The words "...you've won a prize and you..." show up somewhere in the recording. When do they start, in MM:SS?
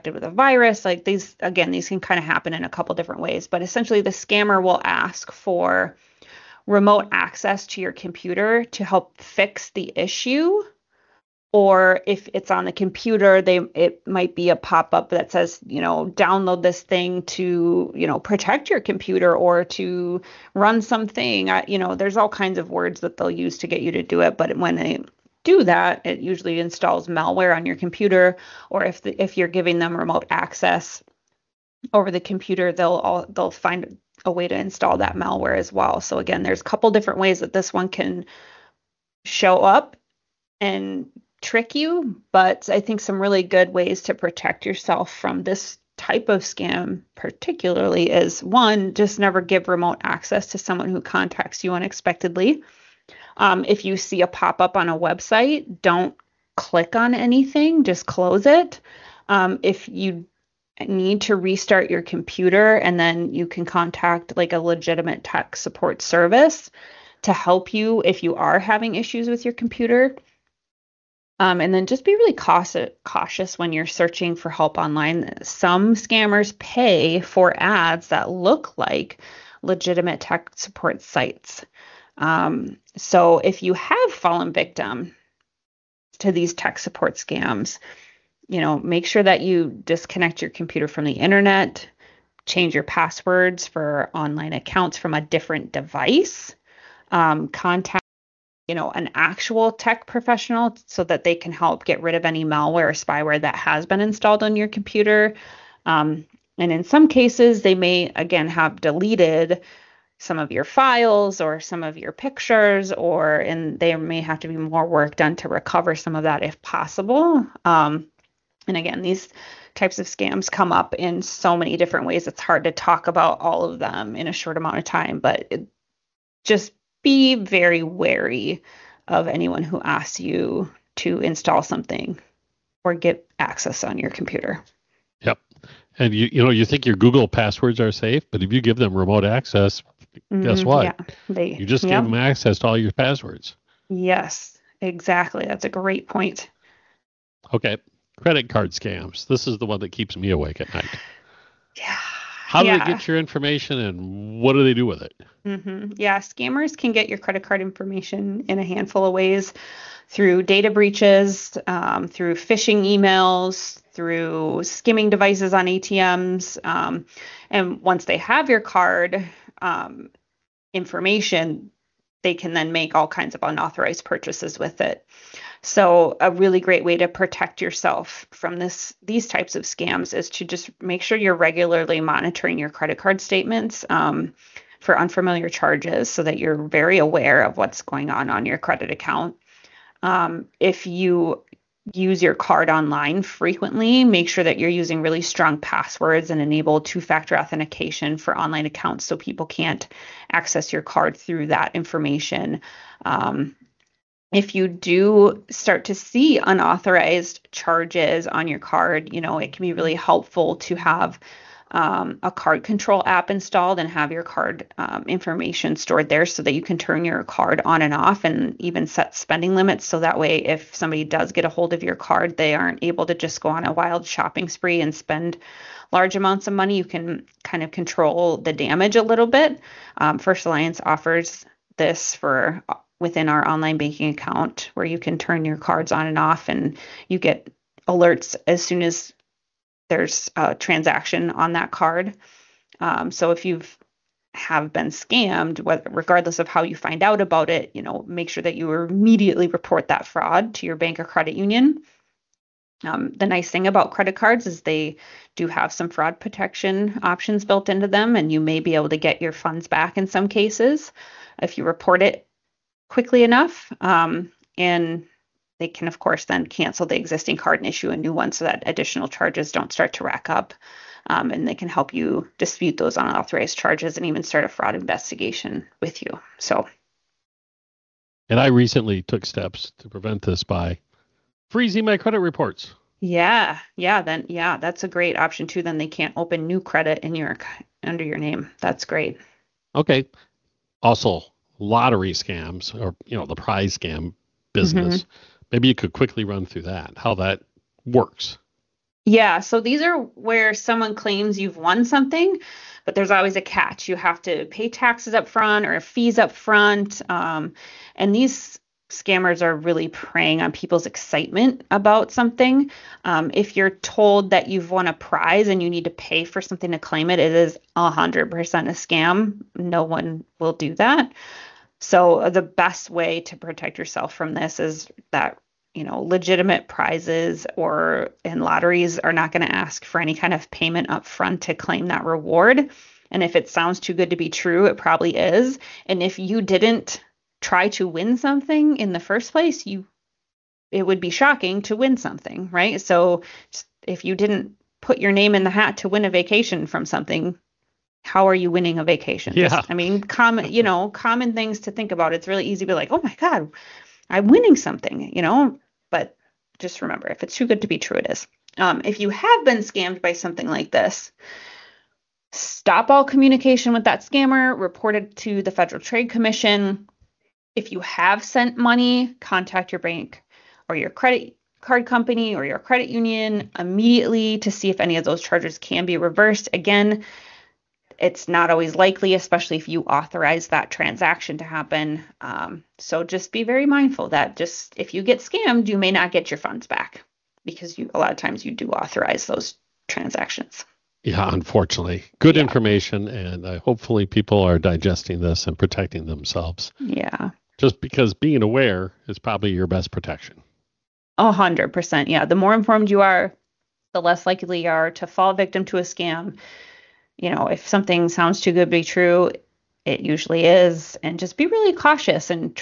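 05:14.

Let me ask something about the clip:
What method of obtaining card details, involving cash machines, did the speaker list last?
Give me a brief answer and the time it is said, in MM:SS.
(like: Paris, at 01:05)
Skimming devices on ATMs, at 02:44.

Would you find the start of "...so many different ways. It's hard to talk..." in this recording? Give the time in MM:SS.
02:01.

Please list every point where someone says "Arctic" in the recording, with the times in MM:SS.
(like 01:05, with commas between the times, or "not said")
not said.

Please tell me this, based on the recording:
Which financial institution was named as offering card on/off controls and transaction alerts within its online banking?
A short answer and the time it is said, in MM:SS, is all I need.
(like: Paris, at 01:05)
First Alliance, at 03:50.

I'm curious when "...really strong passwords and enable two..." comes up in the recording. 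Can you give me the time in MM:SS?
03:15.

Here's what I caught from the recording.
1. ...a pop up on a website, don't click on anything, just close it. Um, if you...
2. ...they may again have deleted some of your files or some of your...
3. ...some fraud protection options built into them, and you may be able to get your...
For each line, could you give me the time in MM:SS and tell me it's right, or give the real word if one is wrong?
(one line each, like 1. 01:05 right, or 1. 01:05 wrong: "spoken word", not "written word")
1. 00:54 right
2. 01:47 right
3. 04:15 right.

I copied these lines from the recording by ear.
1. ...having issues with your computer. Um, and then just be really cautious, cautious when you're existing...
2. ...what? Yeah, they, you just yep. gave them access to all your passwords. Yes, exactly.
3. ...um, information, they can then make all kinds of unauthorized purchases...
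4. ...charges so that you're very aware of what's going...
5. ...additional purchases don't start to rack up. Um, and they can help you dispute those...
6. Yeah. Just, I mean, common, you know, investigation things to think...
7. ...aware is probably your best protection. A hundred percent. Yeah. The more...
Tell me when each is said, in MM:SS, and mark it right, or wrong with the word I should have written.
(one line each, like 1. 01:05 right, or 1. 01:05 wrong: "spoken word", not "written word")
1. 01:08 wrong: "searching", not "existing"
2. 02:20 right
3. 02:49 right
4. 03:05 right
5. 04:28 wrong: "charges", not "purchases"
6. 05:49 wrong: "common", not "investigation"
7. 06:38 right.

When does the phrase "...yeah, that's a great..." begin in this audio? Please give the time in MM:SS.
04:44.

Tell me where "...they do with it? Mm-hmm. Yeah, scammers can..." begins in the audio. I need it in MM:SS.
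02:34.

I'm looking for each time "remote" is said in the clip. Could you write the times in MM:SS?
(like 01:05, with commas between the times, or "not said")
00:06, 00:29, 00:49, 02:18.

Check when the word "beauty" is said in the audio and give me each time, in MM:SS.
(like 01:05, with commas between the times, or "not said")
not said.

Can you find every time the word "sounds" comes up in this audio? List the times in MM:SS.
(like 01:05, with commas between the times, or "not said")
05:33, 06:48.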